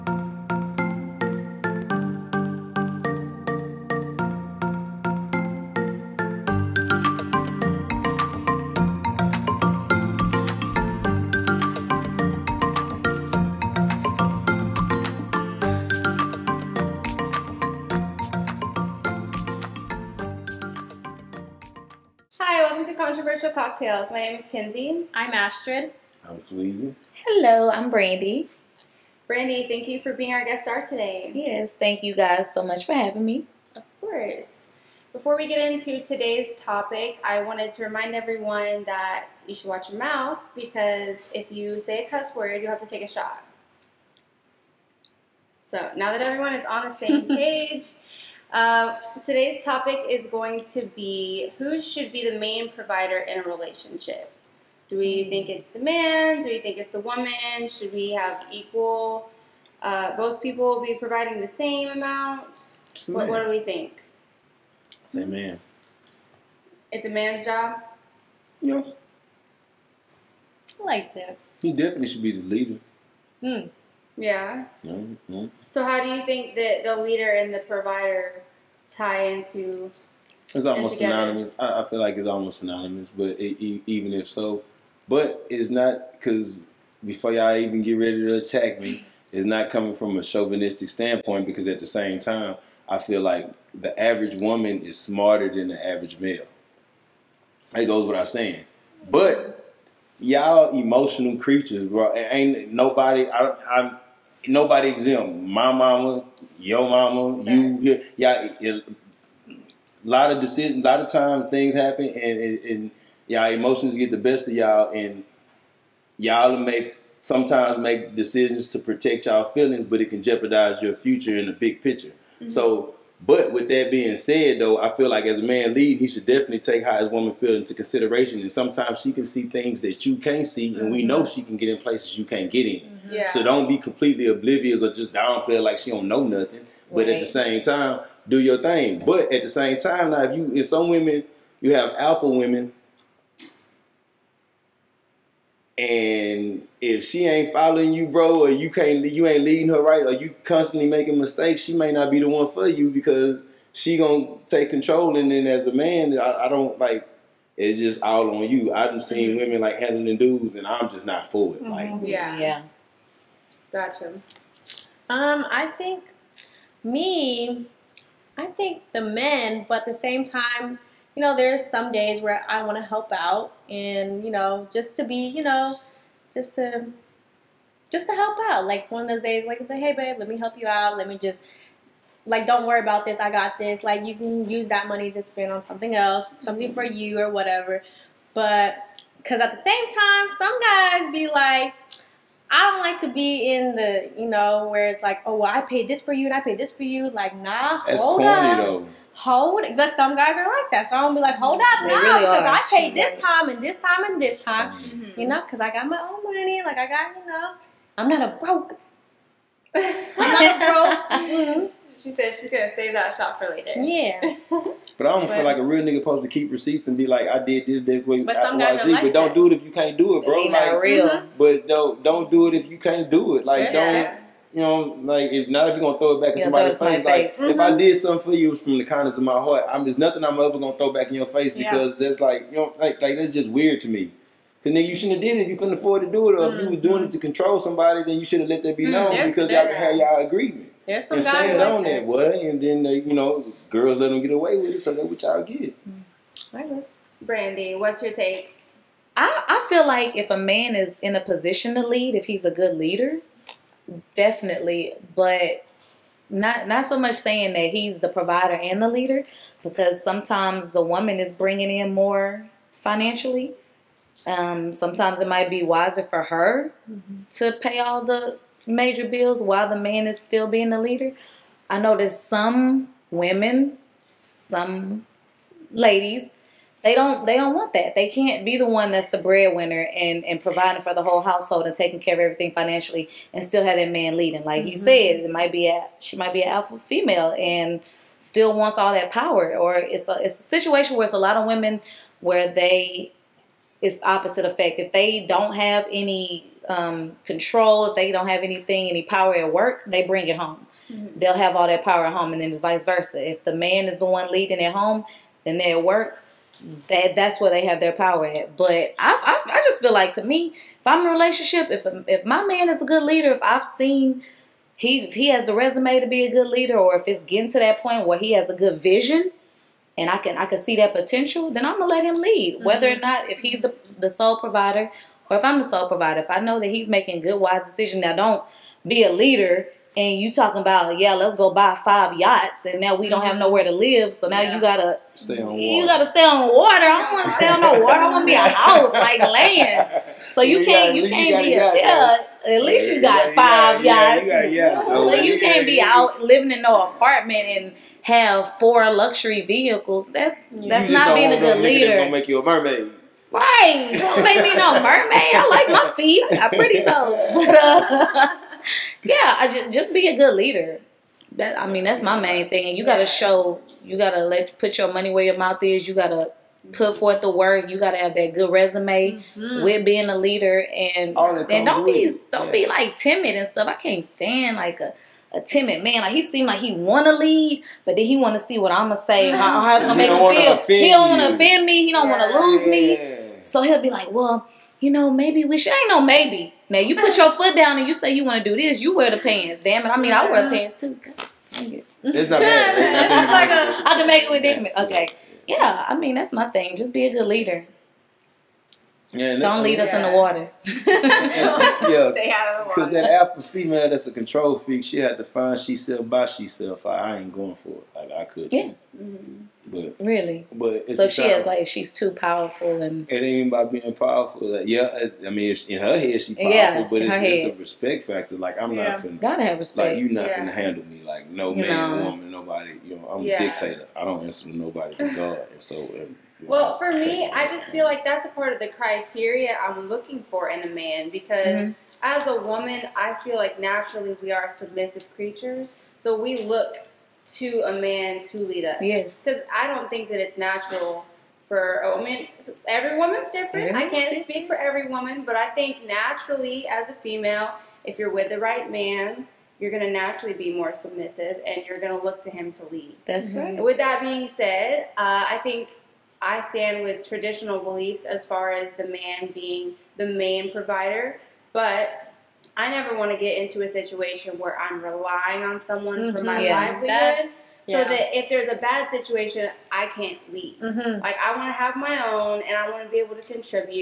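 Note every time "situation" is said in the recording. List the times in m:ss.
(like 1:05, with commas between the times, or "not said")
4:50, 7:43, 7:48.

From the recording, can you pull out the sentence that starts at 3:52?
that's like you know, like like that's just weird to me.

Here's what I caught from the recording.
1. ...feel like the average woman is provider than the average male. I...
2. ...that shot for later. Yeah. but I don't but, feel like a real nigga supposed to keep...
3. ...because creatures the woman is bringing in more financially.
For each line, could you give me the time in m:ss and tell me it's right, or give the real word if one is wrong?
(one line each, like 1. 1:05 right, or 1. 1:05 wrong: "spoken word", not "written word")
1. 1:32 wrong: "smarter", not "provider"
2. 3:32 right
3. 4:19 wrong: "sometimes", not "creatures".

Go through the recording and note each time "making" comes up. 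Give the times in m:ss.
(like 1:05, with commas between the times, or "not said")
2:30, 5:26.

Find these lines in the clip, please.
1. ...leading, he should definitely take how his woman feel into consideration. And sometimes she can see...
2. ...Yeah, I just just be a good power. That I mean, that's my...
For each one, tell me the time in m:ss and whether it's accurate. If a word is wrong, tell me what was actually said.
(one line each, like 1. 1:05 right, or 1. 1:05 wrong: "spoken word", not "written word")
1. 2:05 right
2. 5:59 wrong: "leader", not "power".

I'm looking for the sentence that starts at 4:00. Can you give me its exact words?
There's some and guys like on that, what?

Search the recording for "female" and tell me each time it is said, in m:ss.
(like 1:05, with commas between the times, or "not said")
4:46, 6:43, 7:26.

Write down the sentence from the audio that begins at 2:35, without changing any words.
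And then as a man, I, I don't like.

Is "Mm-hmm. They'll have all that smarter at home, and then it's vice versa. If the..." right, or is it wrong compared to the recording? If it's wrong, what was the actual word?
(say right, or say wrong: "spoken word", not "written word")
wrong: "power", not "smarter".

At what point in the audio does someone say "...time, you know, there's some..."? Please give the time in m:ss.
2:50.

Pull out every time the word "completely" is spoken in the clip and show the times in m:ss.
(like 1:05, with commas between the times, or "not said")
2:13.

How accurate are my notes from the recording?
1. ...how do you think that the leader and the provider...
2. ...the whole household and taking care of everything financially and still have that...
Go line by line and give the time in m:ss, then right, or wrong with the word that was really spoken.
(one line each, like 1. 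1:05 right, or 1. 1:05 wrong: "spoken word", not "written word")
1. 1:15 right
2. 4:40 right.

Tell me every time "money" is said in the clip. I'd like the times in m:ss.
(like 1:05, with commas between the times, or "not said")
3:04, 3:26, 6:04.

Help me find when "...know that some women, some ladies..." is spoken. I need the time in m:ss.
4:31.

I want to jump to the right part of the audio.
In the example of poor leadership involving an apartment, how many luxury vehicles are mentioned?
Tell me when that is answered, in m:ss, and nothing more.
5:48.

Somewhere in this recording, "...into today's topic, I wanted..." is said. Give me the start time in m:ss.
0:35.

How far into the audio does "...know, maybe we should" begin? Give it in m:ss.
6:24.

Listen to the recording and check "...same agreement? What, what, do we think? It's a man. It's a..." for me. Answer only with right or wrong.
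wrong.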